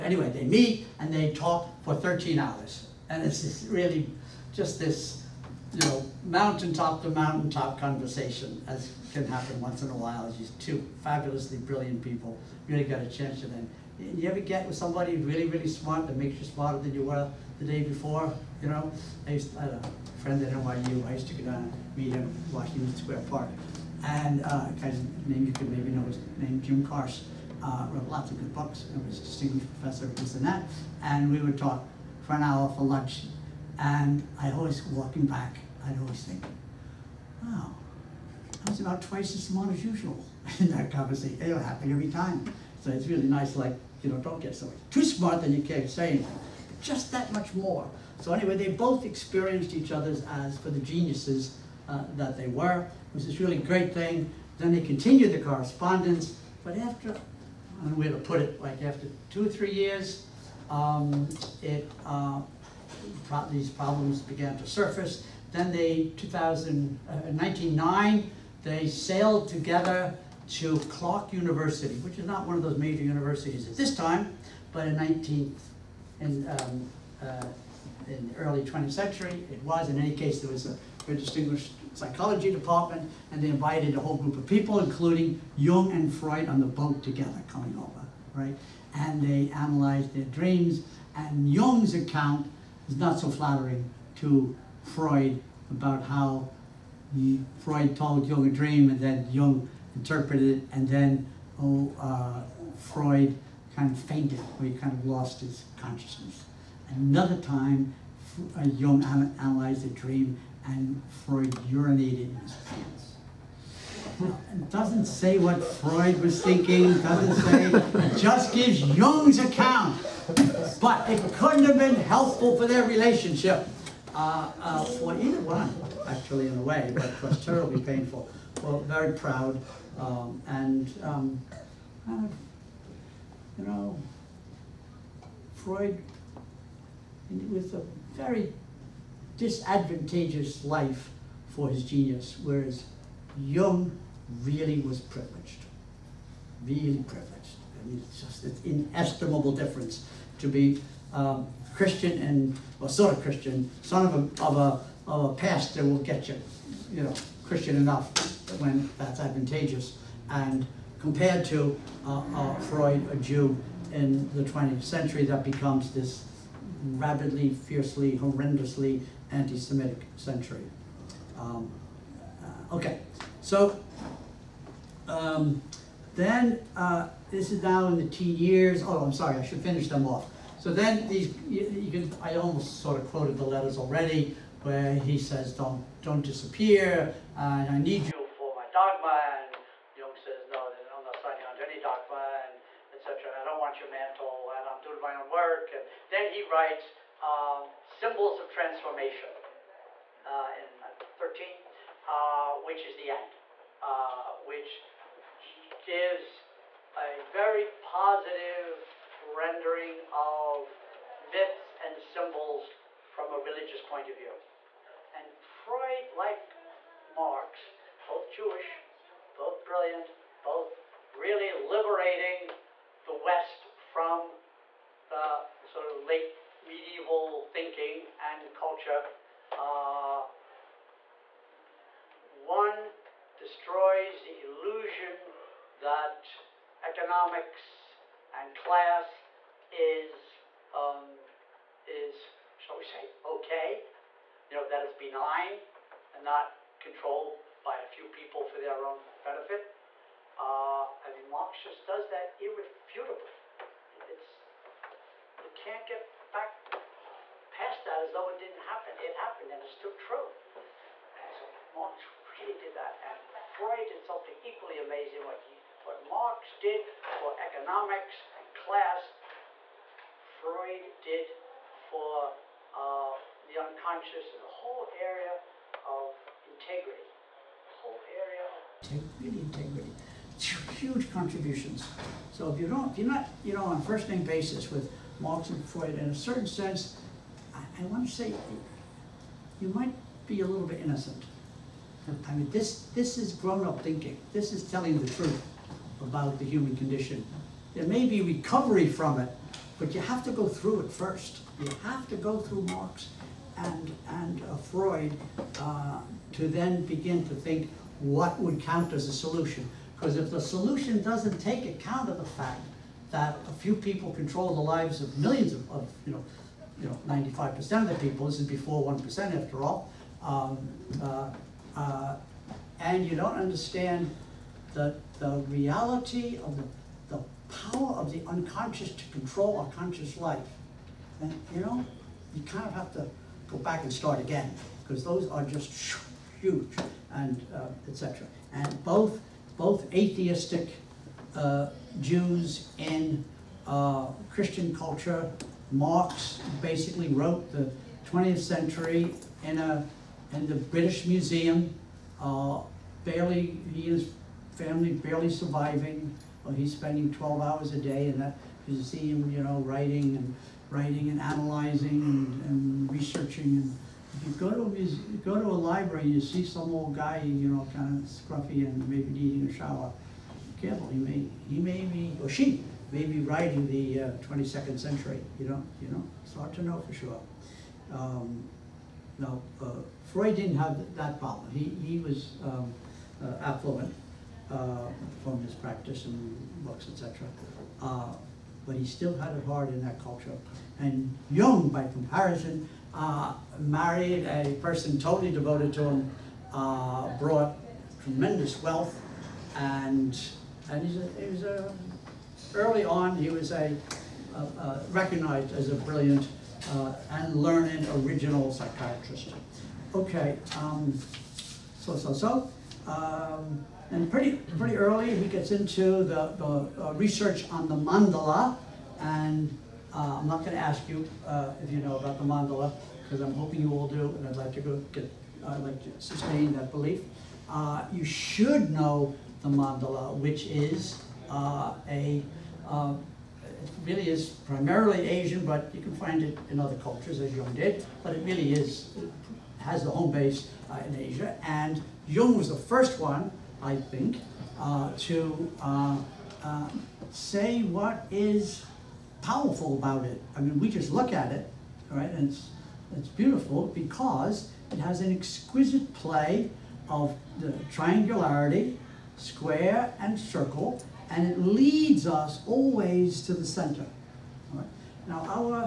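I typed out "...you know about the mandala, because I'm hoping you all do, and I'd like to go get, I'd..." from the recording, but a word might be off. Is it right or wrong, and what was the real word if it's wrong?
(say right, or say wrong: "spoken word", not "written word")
right.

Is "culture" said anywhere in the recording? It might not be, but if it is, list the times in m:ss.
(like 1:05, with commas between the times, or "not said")
3:48, 5:44, 6:30, 7:16.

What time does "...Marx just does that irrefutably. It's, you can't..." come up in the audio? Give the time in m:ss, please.
4:11.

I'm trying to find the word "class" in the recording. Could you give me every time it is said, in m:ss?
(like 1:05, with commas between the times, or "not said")
3:58, 4:28.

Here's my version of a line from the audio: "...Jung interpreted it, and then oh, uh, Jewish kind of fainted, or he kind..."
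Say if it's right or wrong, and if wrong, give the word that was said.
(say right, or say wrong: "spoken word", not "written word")
wrong: "Freud", not "Jewish".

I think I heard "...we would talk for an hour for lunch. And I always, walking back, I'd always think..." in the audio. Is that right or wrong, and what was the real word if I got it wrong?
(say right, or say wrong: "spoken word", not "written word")
right.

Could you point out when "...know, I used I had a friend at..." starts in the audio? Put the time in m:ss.
0:18.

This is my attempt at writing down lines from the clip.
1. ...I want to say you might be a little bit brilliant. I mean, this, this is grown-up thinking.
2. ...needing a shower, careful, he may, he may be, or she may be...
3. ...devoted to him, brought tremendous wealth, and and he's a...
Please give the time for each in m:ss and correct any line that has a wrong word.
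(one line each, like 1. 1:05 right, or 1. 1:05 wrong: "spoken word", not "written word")
1. 4:47 wrong: "innocent", not "brilliant"
2. 6:09 right
3. 6:35 right.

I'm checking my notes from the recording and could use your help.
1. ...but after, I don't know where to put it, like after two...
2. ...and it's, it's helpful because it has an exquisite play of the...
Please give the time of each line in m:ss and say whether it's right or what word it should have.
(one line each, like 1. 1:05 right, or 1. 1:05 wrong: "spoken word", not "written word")
1. 0:56 right
2. 7:32 wrong: "beautiful", not "helpful".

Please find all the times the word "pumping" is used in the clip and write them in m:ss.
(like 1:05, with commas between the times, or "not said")
not said.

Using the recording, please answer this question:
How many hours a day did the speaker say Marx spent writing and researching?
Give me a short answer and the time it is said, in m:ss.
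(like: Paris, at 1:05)
12, at 5:57.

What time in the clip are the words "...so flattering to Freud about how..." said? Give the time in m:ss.
1:33.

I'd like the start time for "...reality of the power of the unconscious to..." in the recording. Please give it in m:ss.
5:25.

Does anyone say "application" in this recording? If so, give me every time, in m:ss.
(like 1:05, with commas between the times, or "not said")
not said.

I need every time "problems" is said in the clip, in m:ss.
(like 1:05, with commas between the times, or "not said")
1:03, 6:21.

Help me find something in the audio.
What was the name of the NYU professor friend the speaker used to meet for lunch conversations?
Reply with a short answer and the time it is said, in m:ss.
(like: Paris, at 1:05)
Jim Carse, at 0:26.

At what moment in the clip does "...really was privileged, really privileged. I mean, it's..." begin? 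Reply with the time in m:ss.
2:24.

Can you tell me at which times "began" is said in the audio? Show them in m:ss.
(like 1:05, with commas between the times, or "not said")
1:04.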